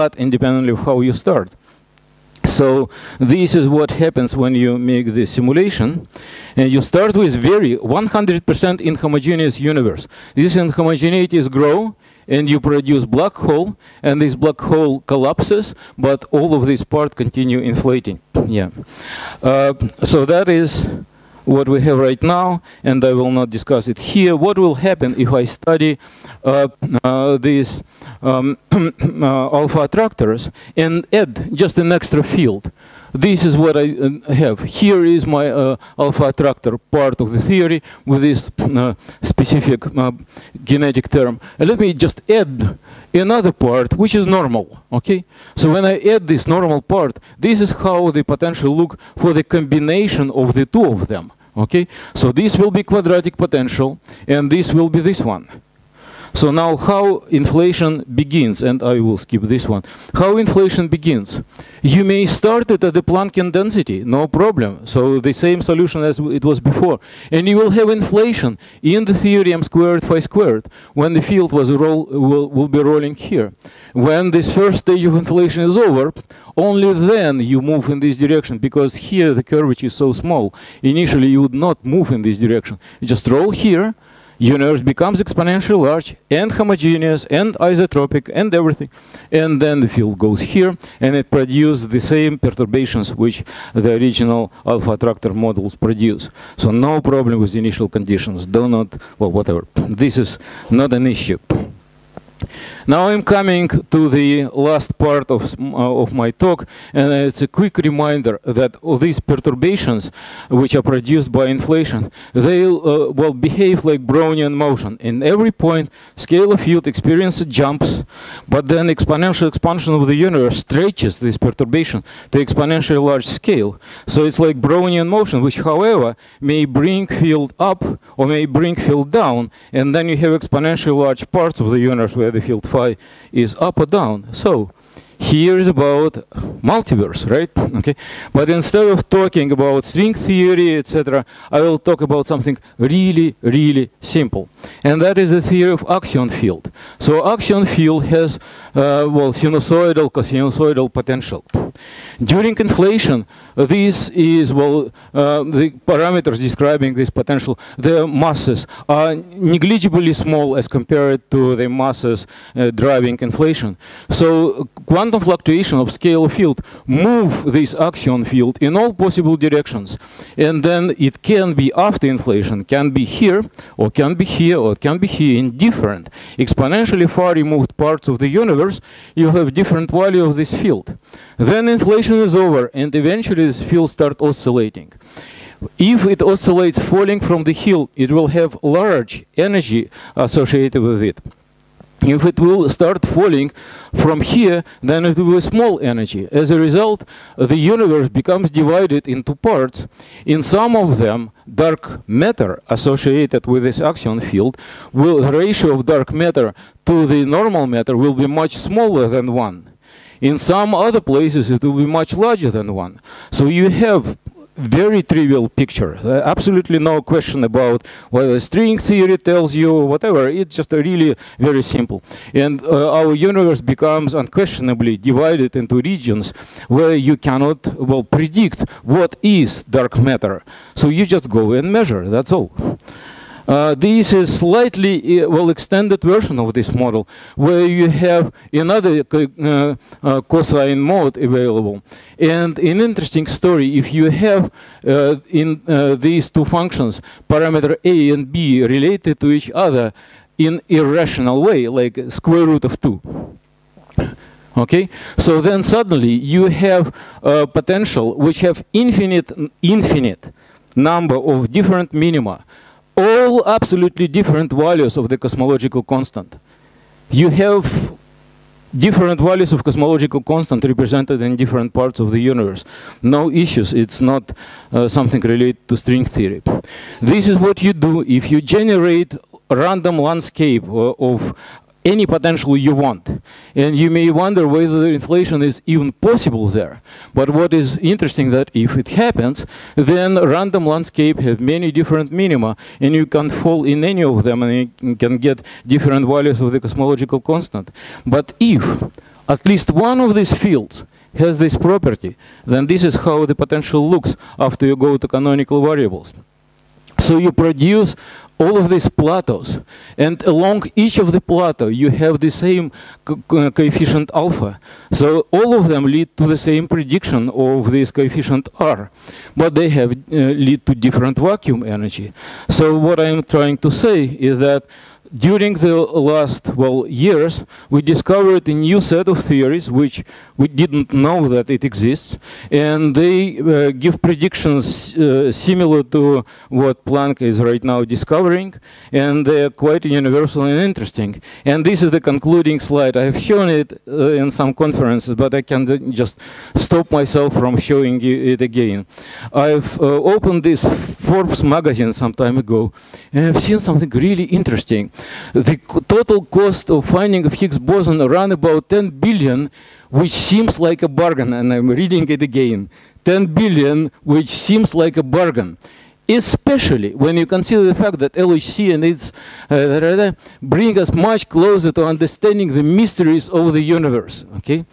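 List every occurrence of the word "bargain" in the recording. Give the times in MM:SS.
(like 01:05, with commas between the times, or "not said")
06:00, 06:05.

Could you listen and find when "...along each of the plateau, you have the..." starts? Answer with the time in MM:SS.
05:10.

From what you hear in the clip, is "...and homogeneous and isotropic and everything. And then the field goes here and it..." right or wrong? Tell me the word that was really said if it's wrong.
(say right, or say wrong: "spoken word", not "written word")
right.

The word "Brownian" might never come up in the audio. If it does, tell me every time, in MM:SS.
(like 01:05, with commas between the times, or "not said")
01:54, 02:04.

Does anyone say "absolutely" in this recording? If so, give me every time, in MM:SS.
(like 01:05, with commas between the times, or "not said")
03:36, 04:23.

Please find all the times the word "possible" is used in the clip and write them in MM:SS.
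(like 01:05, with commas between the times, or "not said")
02:48, 04:45.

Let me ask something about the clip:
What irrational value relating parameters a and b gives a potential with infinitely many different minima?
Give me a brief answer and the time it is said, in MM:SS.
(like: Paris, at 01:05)
square root of 2, at 04:12.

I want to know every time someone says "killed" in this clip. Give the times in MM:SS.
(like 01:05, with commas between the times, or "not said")
not said.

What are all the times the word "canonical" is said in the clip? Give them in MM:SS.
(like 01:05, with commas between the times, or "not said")
05:05.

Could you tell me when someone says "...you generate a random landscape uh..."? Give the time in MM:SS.
04:38.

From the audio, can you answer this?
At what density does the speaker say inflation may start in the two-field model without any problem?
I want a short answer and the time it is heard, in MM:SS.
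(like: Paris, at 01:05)
Planckian density, at 01:03.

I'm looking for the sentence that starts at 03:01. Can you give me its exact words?
Then inflation is over and eventually this field start oscillating.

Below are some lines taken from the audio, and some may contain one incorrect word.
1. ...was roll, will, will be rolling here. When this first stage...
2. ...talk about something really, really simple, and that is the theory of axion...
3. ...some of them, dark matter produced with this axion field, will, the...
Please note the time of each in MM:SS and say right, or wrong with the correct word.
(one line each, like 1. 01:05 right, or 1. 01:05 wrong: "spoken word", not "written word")
1. 01:11 right
2. 02:21 right
3. 03:20 wrong: "associated", not "produced".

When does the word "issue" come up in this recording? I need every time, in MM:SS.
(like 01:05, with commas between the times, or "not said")
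01:41, 04:33.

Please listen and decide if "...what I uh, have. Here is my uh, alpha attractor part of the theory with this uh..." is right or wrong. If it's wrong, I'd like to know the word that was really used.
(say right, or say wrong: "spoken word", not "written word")
right.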